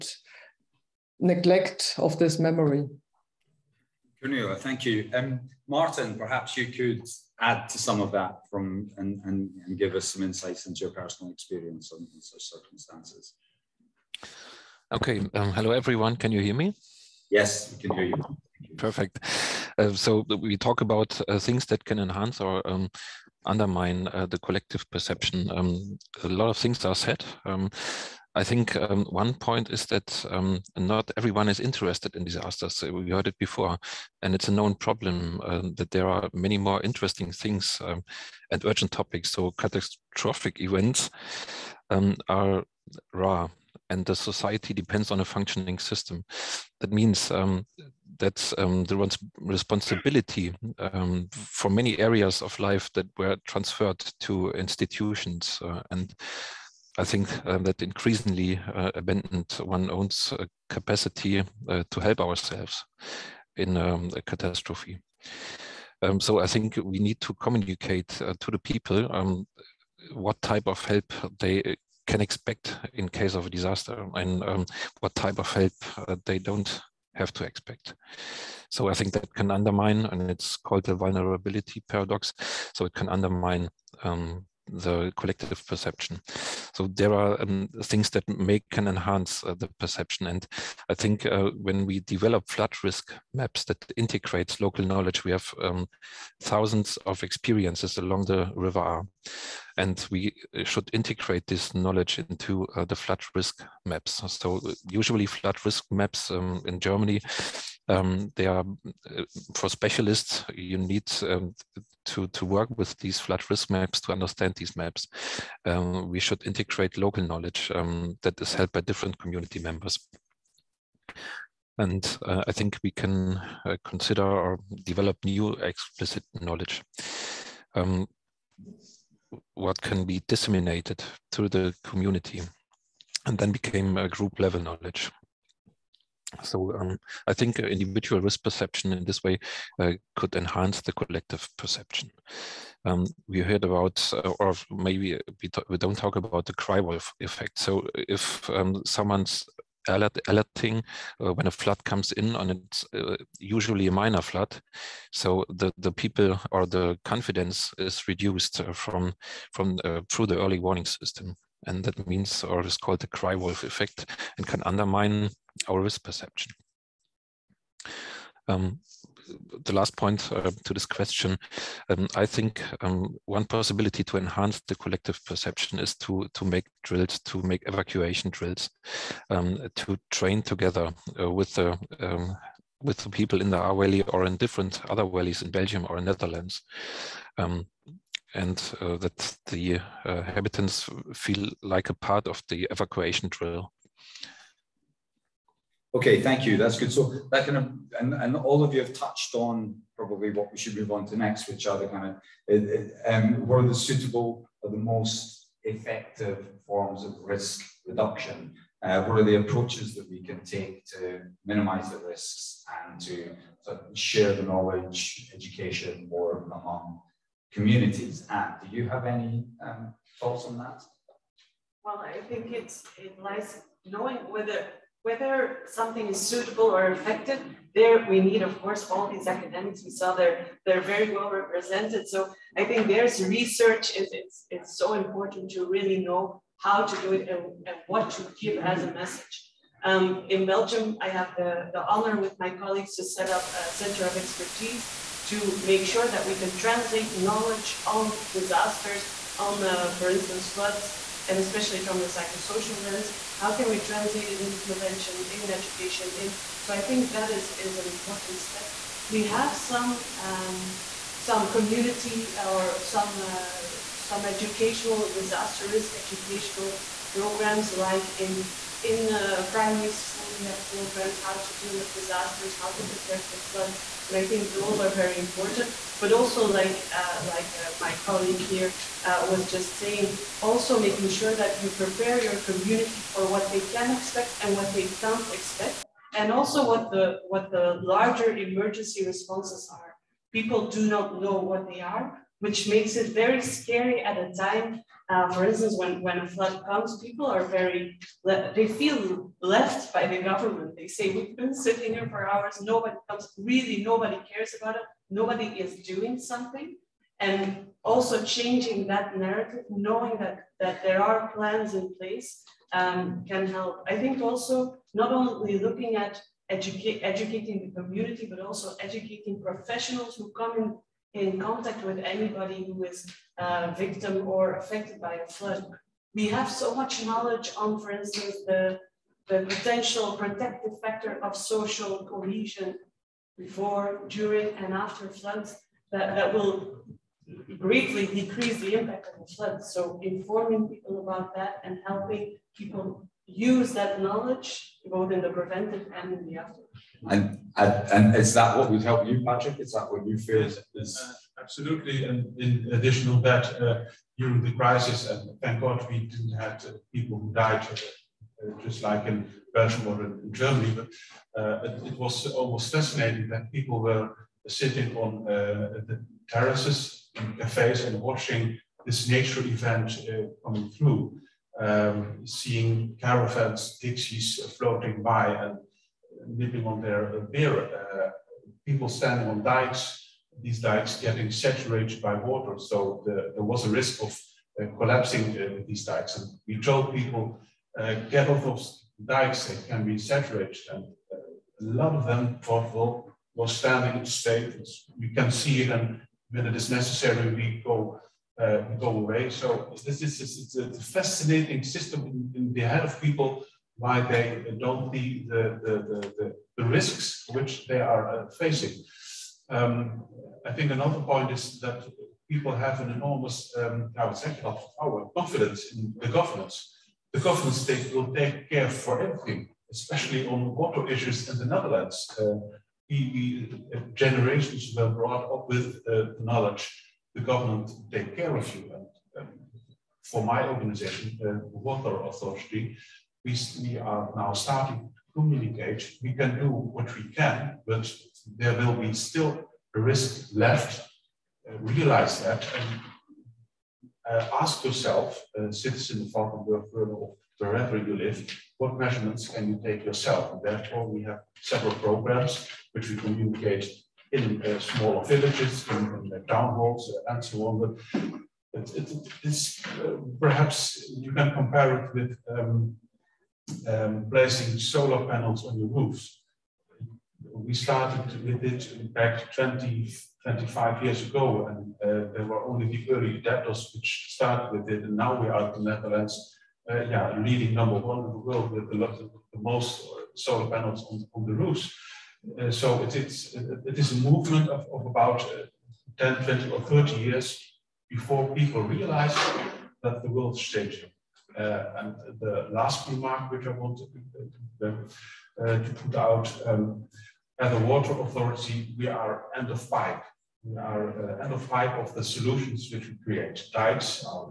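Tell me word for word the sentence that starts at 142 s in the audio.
Um, we heard about, uh, or maybe we, we, don't talk about the cry wolf effect.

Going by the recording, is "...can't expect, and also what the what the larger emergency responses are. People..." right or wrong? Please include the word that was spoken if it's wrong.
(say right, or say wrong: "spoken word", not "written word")
right.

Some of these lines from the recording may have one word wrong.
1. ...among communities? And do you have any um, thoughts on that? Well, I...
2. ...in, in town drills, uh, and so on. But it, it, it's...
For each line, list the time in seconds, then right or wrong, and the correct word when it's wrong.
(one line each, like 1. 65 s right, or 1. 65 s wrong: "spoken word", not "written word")
1. 216 s right
2. 455 s wrong: "halls", not "drills".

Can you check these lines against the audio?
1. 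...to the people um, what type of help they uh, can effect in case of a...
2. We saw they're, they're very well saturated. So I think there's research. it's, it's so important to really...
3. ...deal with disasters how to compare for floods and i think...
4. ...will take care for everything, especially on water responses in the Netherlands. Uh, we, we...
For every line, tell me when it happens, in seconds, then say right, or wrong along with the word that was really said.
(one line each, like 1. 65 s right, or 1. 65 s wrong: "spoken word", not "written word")
1. 68 s wrong: "expect", not "effect"
2. 229 s wrong: "represented", not "saturated"
3. 271 s wrong: "prepare", not "compare"
4. 417 s wrong: "issues", not "responses".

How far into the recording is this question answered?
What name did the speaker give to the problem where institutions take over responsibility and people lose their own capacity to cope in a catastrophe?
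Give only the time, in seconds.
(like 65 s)
80 s.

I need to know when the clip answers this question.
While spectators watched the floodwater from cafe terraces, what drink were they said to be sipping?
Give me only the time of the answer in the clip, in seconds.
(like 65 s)
377 s.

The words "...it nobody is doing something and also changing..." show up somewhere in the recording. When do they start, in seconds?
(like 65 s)
304 s.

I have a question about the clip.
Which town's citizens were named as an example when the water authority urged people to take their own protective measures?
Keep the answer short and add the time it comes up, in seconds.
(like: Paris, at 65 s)
Valkenburg, at 446 s.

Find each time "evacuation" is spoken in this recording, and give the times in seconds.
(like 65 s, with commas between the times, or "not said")
177 s, 192 s.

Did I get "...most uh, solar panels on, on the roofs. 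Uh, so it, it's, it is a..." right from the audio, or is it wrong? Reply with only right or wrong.
right.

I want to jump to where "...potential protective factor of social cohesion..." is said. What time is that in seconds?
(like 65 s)
329 s.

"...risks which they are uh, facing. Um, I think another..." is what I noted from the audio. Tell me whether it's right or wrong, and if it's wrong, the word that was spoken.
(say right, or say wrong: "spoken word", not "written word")
right.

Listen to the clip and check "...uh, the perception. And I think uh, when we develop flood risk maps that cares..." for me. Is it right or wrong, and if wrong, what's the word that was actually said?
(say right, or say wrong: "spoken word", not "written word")
wrong: "integrates", not "cares".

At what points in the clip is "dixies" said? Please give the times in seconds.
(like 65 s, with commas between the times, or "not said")
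373 s.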